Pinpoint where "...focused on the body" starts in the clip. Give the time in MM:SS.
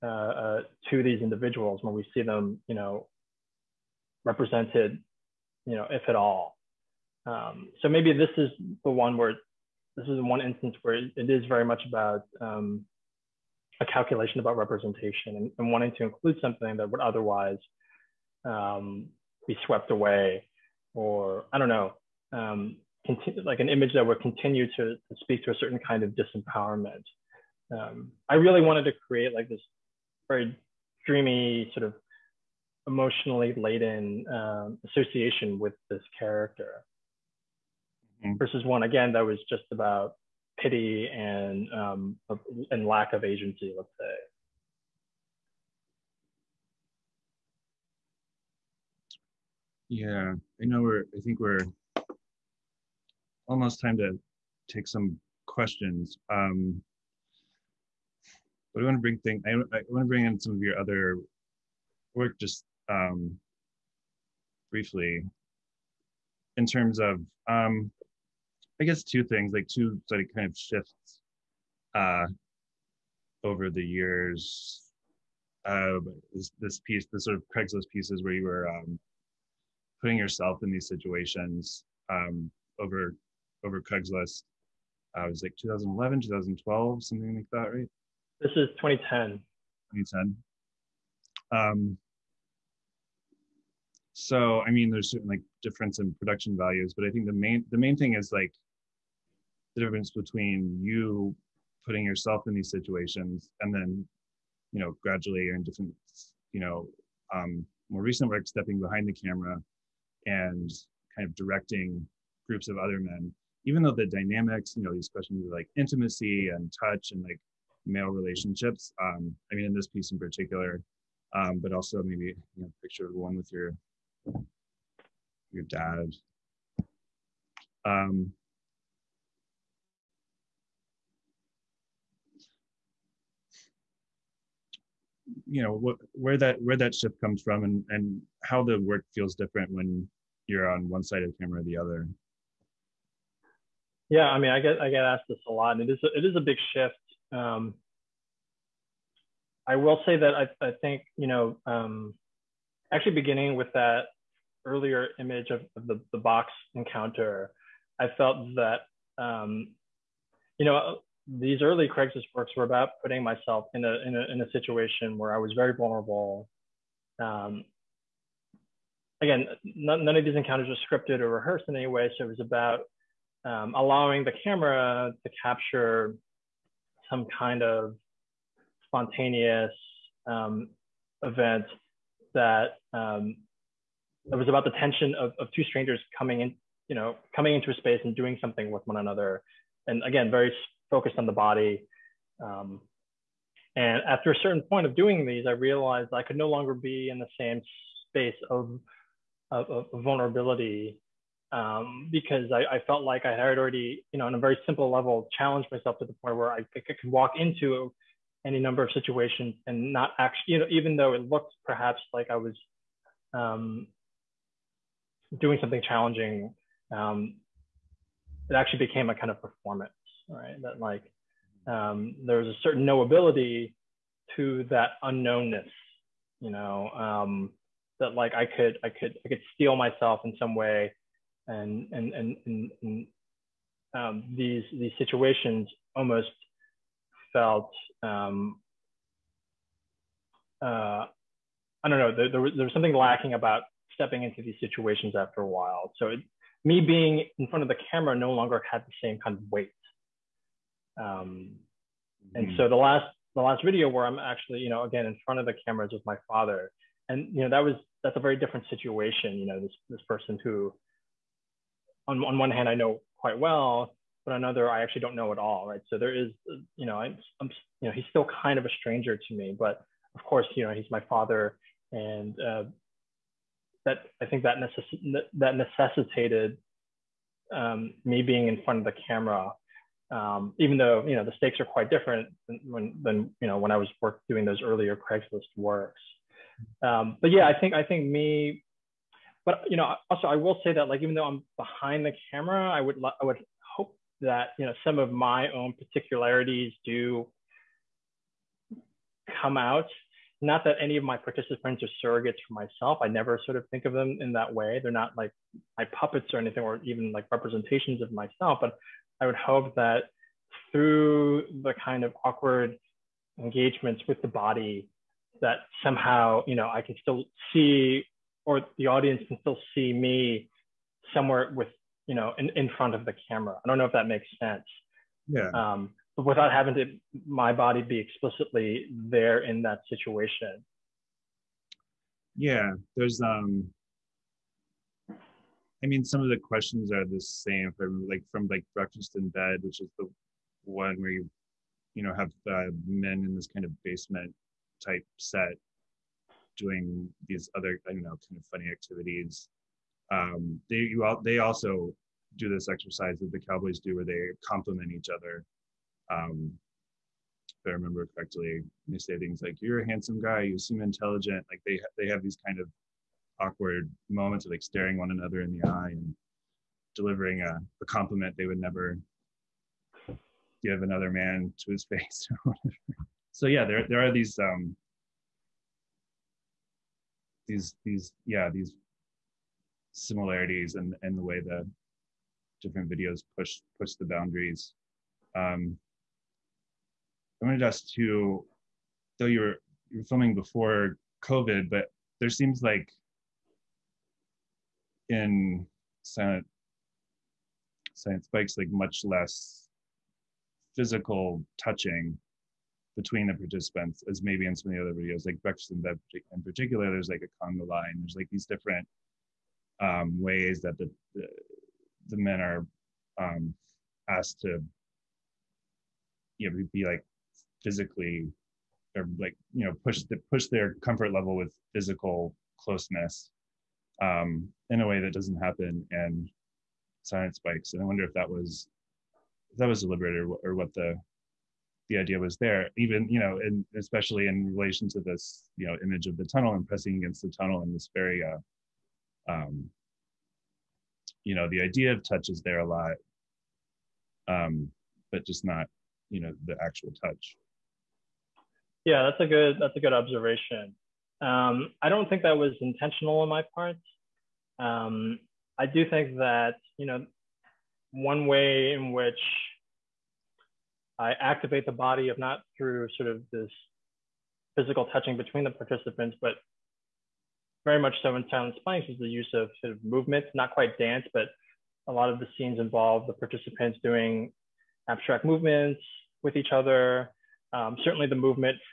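03:10.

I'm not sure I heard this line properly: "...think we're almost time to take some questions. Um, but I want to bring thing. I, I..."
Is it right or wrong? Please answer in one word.
right.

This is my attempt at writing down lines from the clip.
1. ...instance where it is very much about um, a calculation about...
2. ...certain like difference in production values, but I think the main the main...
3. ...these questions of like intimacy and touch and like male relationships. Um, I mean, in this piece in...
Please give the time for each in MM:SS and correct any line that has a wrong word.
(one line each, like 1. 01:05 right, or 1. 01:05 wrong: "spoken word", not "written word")
1. 00:10 right
2. 01:35 right
3. 01:54 right.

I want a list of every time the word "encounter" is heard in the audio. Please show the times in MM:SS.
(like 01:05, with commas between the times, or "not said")
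02:36, 02:50.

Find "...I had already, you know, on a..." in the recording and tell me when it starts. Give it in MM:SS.
03:23.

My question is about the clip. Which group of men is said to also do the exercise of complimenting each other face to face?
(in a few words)
The Cowboys.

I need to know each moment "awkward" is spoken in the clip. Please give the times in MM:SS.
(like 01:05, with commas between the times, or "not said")
05:12, 06:03.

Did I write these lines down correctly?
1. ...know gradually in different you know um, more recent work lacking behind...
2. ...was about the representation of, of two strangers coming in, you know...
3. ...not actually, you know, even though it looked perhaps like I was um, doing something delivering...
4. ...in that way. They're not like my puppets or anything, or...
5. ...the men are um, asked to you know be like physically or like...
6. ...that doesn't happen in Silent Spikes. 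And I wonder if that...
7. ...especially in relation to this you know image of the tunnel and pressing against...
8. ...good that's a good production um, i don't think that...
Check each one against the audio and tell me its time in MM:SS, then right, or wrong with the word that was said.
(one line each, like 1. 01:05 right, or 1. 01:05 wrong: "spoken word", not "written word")
1. 01:44 wrong: "stepping", not "lacking"
2. 03:04 wrong: "tension", not "representation"
3. 03:29 wrong: "challenging", not "delivering"
4. 05:04 right
5. 06:52 right
6. 07:05 right
7. 07:13 right
8. 07:29 wrong: "observation", not "production".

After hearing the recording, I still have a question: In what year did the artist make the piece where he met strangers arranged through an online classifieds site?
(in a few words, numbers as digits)
2010.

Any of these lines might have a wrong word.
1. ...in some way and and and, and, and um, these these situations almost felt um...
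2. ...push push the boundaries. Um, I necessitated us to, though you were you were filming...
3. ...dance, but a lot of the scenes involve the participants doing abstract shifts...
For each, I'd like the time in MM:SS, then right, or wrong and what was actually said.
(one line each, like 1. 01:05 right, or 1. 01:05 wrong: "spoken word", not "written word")
1. 03:50 right
2. 06:23 wrong: "wanted", not "necessitated"
3. 07:50 wrong: "movements", not "shifts".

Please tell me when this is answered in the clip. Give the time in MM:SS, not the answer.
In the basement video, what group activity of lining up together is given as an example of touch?
06:47.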